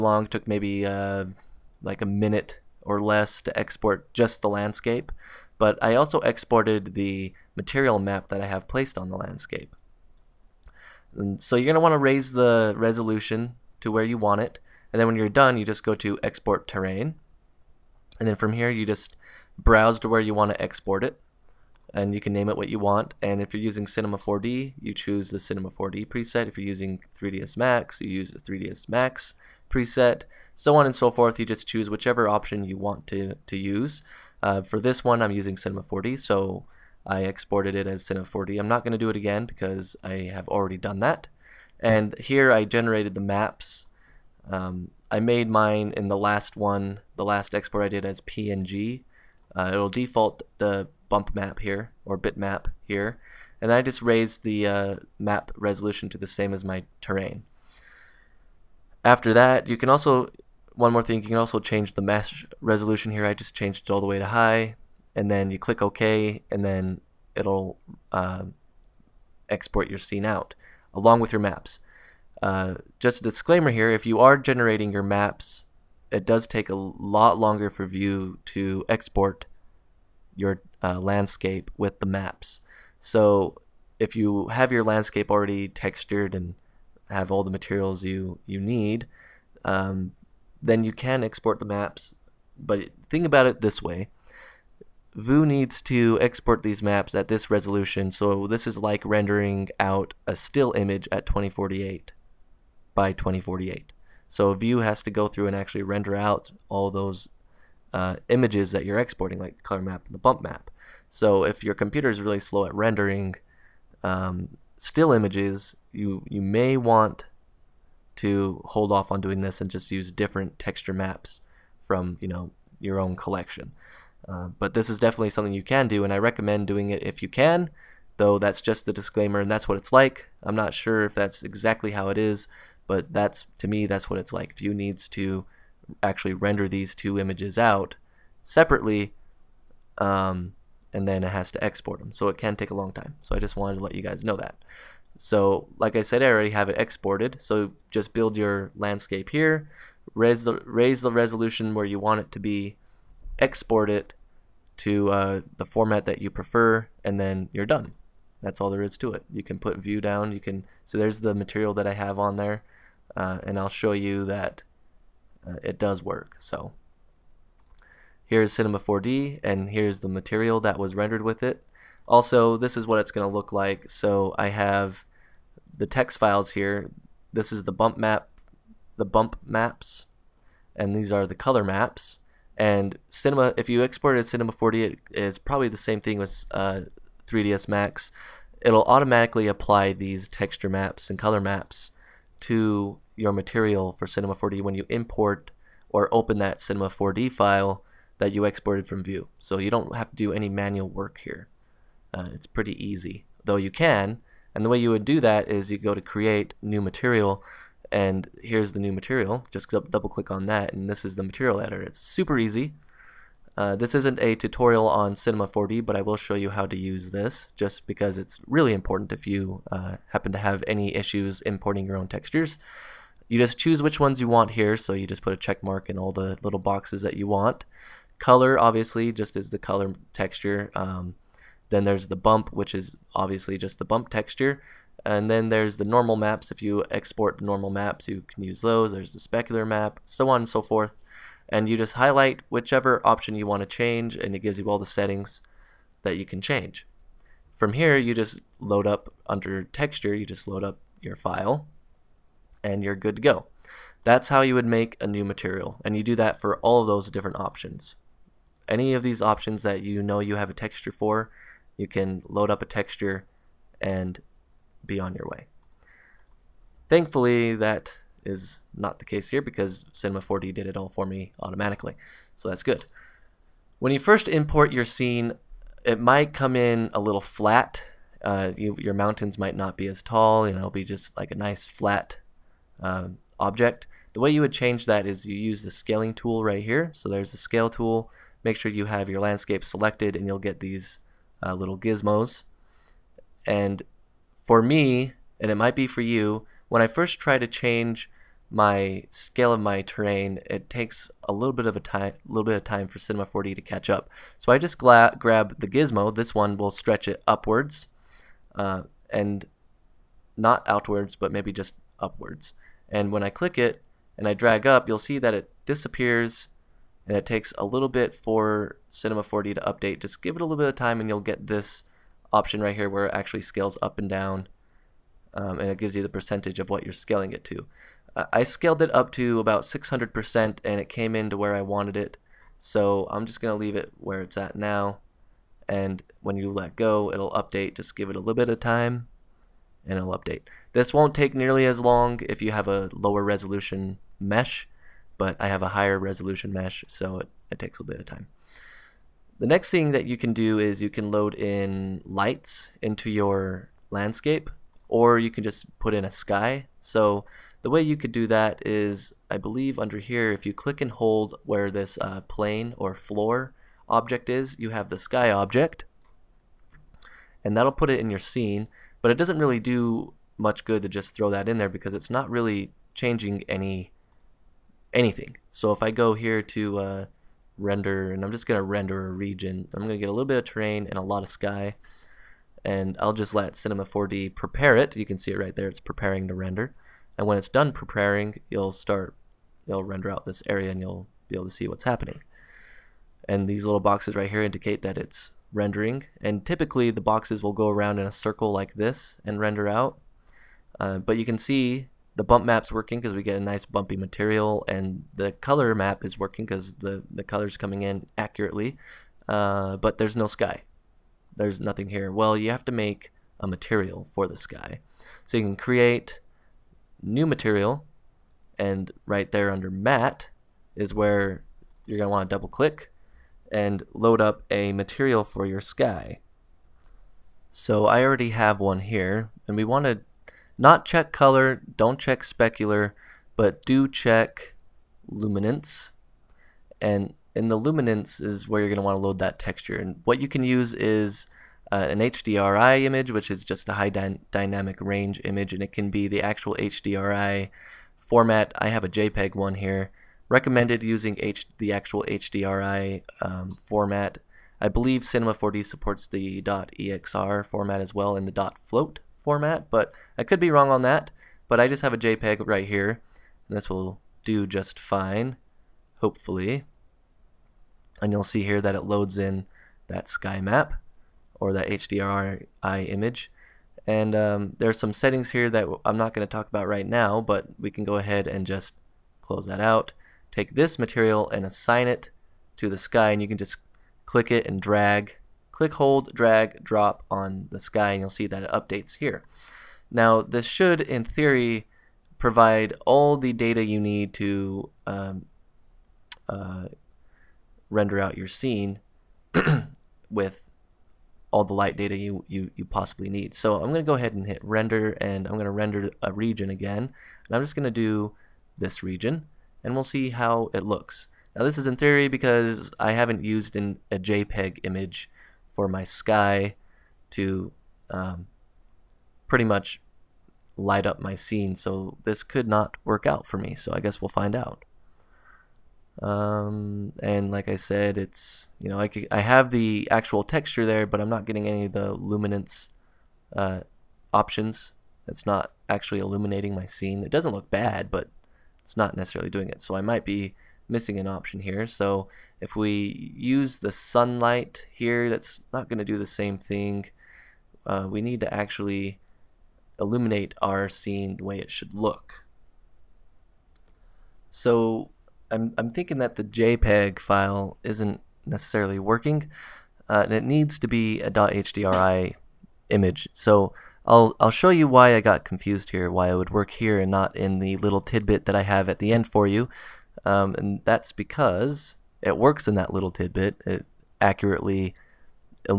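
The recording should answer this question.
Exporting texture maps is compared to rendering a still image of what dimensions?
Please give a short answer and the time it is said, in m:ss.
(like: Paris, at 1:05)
2048 by 2048, at 1:41.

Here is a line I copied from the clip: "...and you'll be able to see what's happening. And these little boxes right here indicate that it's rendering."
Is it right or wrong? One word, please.
right.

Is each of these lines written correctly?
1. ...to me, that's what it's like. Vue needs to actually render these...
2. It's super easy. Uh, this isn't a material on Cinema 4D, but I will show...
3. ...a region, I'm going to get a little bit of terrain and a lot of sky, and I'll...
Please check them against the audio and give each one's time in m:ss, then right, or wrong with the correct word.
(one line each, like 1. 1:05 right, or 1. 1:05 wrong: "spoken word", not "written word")
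1. 2:13 right
2. 3:31 wrong: "tutorial", not "material"
3. 6:19 right.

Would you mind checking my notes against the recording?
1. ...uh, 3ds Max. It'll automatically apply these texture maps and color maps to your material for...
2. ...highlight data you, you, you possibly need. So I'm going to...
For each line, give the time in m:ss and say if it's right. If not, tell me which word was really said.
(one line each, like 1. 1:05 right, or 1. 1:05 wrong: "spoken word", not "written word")
1. 3:06 right
2. 8:21 wrong: "light", not "highlight".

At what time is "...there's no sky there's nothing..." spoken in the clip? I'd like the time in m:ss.
6:49.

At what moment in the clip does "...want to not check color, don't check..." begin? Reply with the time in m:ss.
7:09.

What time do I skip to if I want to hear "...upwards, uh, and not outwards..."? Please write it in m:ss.
5:07.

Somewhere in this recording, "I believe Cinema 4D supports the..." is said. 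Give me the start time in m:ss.
7:34.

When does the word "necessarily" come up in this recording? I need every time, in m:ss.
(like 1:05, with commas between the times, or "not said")
8:58, 9:18.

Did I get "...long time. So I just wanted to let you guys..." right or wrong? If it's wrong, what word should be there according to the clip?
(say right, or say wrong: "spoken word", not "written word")
right.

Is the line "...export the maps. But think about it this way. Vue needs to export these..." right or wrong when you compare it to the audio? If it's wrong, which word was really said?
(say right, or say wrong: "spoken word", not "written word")
right.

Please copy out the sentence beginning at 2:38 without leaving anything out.
That's all there is to it.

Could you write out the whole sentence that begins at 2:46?
So here's Cinema 4D, and here's the material that was rendered with it.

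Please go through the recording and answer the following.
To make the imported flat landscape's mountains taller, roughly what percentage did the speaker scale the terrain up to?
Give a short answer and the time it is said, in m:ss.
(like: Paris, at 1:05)
600%, at 5:29.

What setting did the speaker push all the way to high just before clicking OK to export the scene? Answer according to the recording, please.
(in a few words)
Mesh resolution.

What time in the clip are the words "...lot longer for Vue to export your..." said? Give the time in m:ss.
1:16.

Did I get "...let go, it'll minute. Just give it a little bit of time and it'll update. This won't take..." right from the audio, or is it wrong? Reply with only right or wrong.
wrong.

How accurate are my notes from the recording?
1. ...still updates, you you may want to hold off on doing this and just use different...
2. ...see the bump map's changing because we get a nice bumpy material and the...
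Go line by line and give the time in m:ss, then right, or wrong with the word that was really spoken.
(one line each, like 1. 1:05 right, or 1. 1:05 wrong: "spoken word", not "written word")
1. 1:54 wrong: "images", not "updates"
2. 6:41 wrong: "working", not "changing".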